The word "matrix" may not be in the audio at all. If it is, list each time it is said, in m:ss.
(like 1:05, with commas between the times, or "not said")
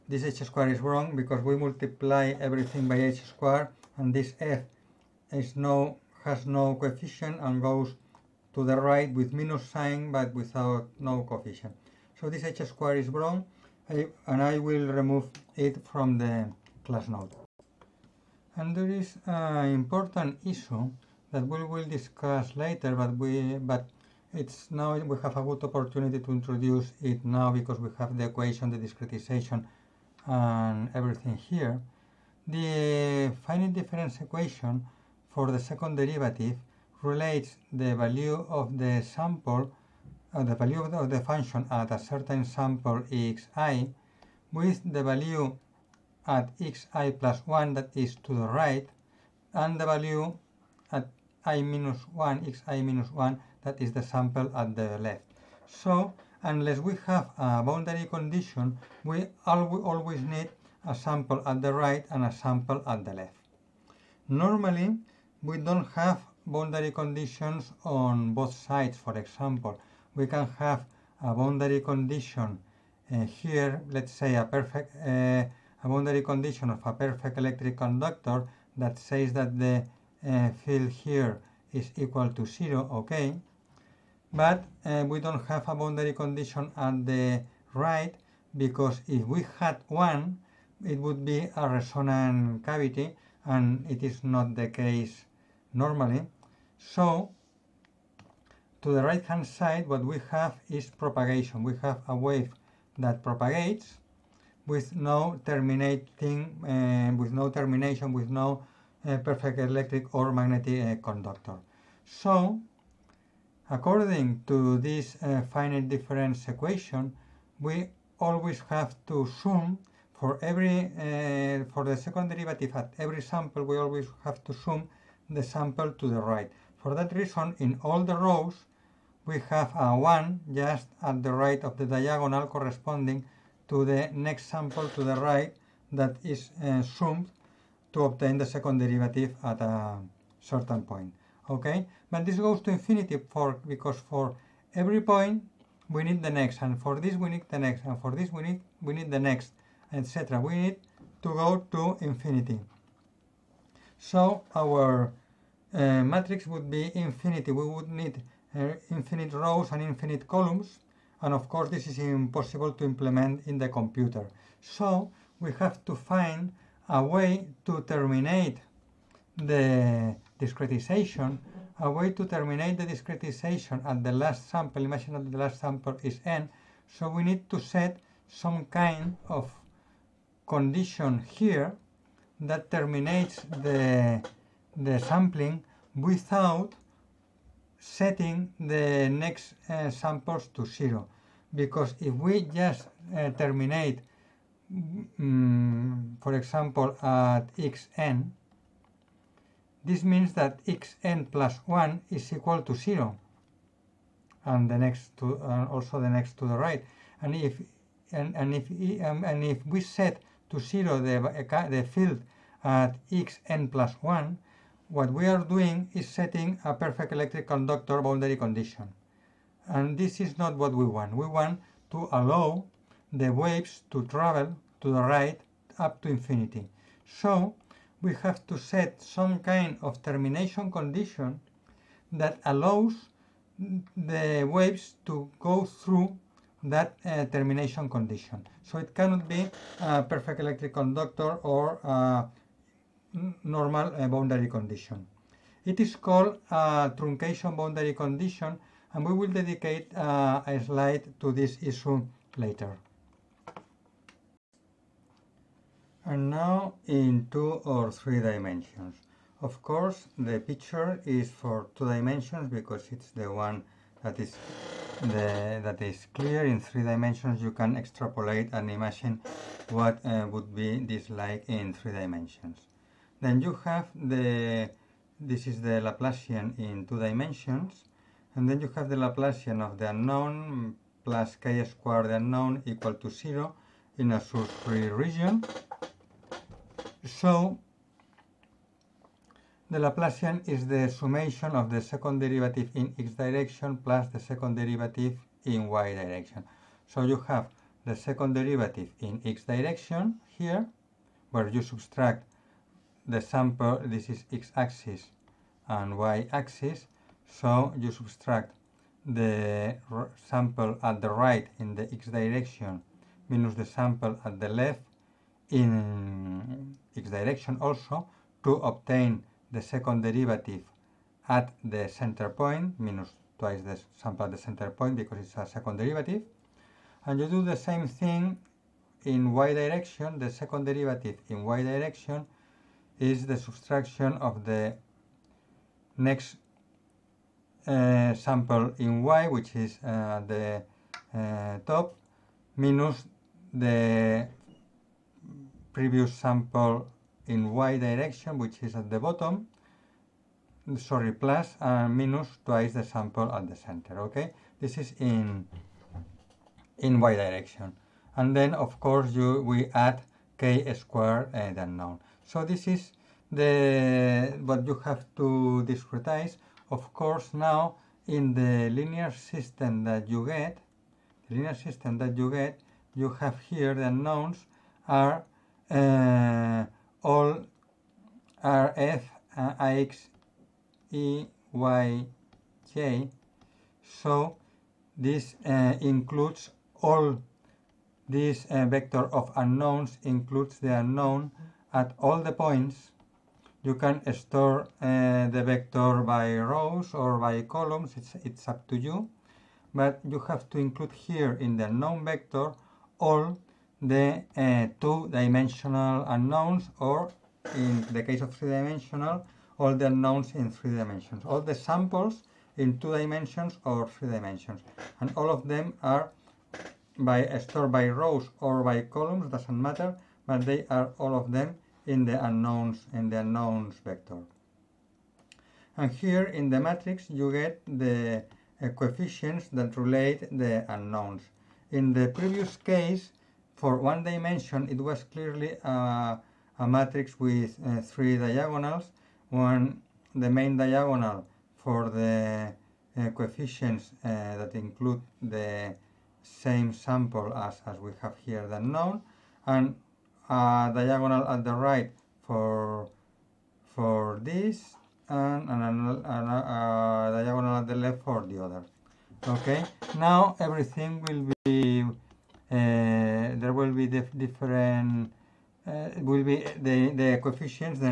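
2:36, 7:06, 7:16.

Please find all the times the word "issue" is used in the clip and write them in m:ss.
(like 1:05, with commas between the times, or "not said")
0:20, 4:11.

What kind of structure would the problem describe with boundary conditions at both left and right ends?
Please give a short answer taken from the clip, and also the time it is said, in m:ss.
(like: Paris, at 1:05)
resonant cavity, at 1:31.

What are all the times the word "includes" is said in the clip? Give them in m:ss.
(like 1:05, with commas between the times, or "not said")
6:25, 6:30, 6:40, 7:24.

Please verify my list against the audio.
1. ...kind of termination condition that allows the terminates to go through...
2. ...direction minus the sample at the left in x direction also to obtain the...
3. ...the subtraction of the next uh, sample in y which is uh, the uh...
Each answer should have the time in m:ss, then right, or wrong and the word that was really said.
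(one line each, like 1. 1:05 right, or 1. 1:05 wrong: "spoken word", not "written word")
1. 3:49 wrong: "waves", not "terminates"
2. 5:12 right
3. 5:33 right.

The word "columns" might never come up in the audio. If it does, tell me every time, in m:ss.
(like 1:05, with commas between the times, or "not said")
2:40, 6:37, 6:58.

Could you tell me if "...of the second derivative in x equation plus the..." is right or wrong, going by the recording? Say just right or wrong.
wrong.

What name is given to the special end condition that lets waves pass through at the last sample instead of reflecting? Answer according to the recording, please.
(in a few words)
truncation boundary condition.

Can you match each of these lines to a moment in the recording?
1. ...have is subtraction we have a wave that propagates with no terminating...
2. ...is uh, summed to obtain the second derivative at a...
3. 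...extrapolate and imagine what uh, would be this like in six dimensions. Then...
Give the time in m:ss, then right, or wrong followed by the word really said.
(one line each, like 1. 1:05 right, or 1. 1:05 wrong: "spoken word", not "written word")
1. 1:40 wrong: "propagation", not "subtraction"
2. 2:16 right
3. 4:27 wrong: "three", not "six".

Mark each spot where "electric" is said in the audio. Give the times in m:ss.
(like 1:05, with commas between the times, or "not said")
1:17, 1:49, 3:37, 4:00.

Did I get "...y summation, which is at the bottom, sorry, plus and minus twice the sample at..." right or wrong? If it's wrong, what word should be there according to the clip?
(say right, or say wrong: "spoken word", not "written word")
wrong: "direction", not "summation".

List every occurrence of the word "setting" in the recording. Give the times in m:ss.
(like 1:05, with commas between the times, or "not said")
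3:07, 3:36.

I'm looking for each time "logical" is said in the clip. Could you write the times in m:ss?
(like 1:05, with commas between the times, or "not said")
not said.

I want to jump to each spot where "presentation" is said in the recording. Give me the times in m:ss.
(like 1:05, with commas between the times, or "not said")
not said.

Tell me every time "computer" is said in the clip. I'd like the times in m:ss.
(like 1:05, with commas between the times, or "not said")
2:43.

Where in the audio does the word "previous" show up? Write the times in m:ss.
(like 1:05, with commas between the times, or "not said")
5:45, 7:12.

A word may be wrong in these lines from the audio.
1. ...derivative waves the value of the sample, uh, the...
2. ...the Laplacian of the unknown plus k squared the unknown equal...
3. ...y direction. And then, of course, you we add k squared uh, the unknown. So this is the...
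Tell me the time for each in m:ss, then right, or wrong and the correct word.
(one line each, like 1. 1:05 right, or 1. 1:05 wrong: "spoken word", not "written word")
1. 0:35 wrong: "relates", not "waves"
2. 4:38 right
3. 5:56 right.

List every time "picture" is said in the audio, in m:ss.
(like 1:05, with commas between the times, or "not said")
4:20.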